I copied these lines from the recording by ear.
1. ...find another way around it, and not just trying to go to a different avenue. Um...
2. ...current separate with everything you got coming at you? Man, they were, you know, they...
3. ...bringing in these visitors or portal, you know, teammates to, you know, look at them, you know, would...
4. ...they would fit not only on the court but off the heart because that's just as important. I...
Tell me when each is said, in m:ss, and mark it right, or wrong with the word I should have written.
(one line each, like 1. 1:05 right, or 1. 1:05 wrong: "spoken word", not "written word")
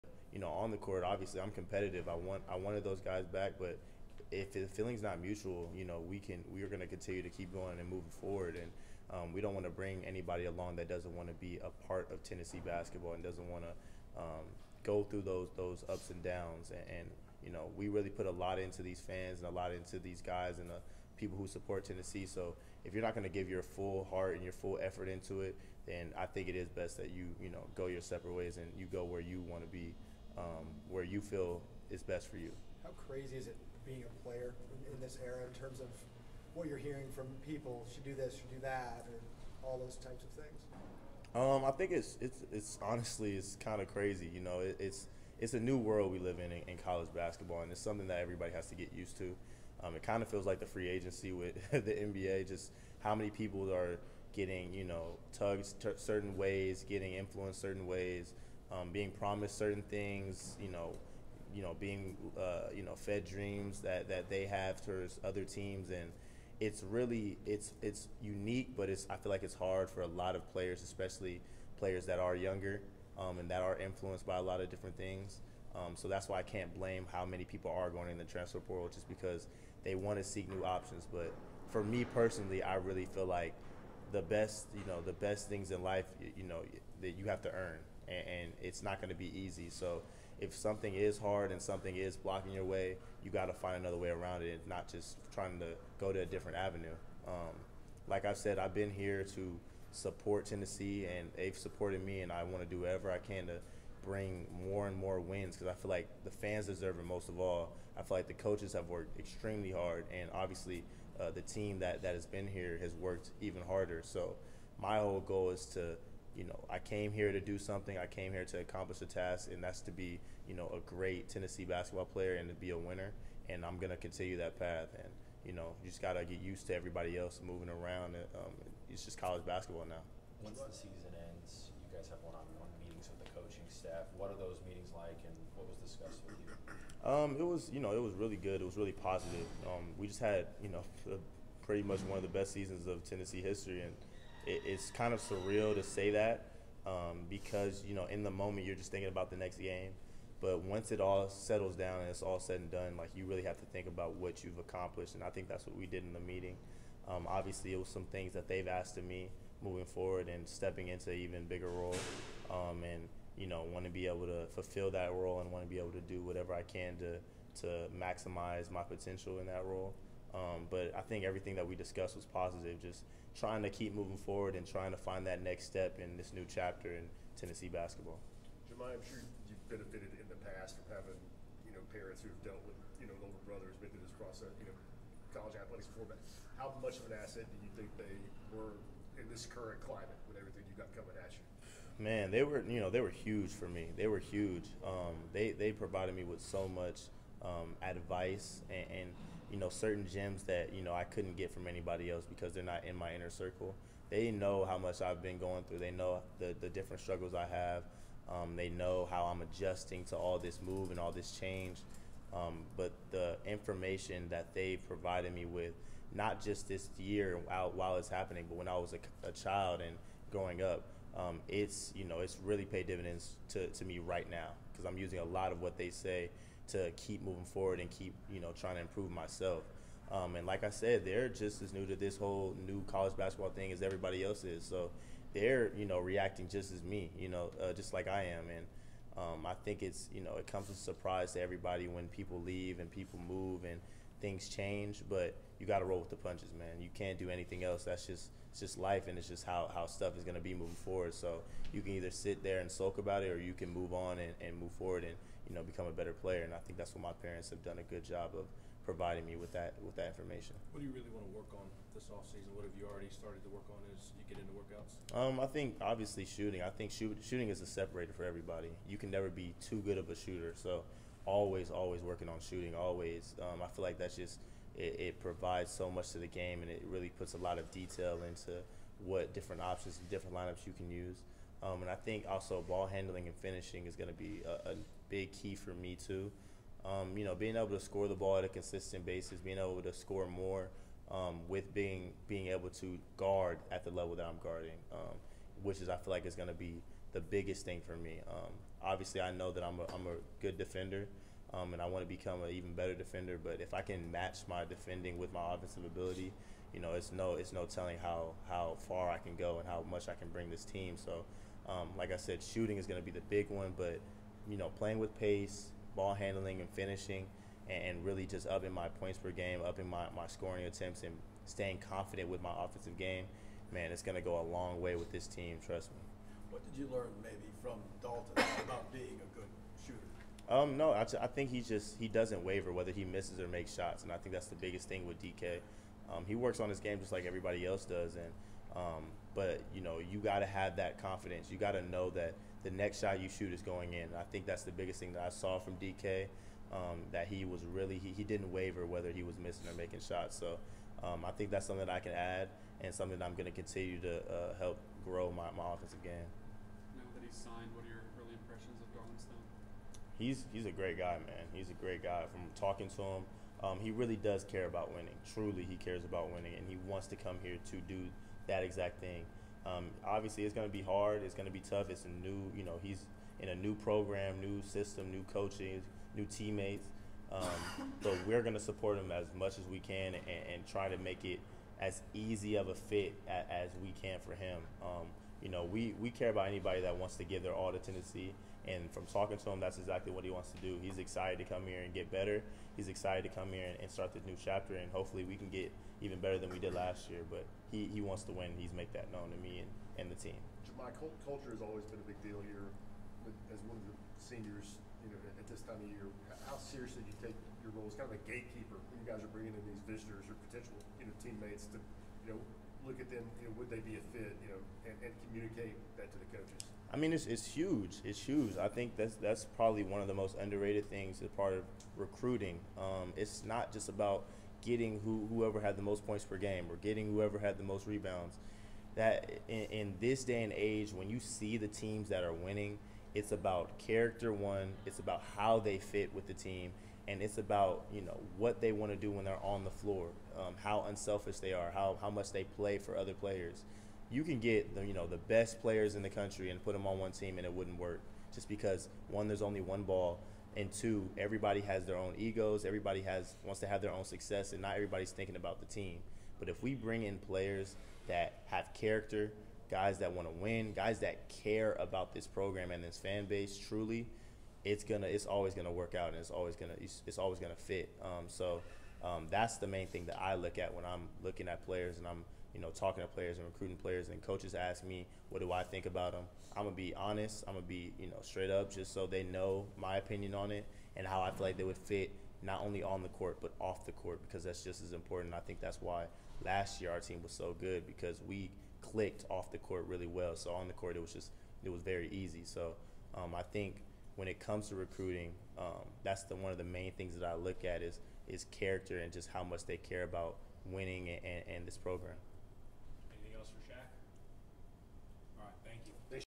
1. 1:33 right
2. 3:09 wrong: "climate", not "separate"
3. 6:49 wrong: "potential", not "portal"
4. 8:01 wrong: "court", not "heart".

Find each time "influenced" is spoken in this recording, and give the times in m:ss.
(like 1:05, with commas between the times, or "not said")
0:57, 1:13.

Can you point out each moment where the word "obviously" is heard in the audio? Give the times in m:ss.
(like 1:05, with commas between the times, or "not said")
0:01, 1:50, 2:37, 4:25, 4:58, 6:10.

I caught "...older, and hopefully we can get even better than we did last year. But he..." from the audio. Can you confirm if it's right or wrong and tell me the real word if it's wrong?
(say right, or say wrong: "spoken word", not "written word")
wrong: "chapter", not "older".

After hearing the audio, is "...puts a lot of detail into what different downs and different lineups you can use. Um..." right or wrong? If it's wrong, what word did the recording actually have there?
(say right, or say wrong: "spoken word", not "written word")
wrong: "options", not "downs".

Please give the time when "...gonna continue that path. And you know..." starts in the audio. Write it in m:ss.
2:03.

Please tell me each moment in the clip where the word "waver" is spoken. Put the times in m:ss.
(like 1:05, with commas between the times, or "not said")
5:32, 5:48.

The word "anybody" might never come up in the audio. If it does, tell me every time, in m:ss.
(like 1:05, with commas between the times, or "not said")
0:10, 3:21, 6:26.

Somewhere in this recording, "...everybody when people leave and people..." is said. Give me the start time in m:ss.
4:01.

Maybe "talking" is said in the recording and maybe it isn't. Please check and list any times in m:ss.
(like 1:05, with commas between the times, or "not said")
6:02, 6:29, 7:52.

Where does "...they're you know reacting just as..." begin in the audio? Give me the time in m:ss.
3:55.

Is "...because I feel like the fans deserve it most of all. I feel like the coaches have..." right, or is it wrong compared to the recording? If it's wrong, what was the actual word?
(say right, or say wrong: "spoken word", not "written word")
right.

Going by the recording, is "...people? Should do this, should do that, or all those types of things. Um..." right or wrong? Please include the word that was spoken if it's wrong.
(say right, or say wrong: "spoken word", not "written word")
right.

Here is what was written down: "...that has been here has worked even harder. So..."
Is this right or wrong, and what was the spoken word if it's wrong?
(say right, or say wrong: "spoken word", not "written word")
right.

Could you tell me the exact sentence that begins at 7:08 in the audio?
That in, in this day and age, when you see the teams that are winning, it's about character one.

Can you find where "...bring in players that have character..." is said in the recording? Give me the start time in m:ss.
7:36.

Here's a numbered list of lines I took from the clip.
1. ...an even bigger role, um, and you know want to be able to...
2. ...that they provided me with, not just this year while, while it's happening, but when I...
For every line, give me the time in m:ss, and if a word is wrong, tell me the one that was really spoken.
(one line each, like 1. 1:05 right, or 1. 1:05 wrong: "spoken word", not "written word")
1. 2:41 right
2. 3:34 right.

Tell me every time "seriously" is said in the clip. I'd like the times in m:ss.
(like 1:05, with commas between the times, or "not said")
6:46.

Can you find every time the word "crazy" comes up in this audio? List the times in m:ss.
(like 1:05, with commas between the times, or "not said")
0:33, 0:43.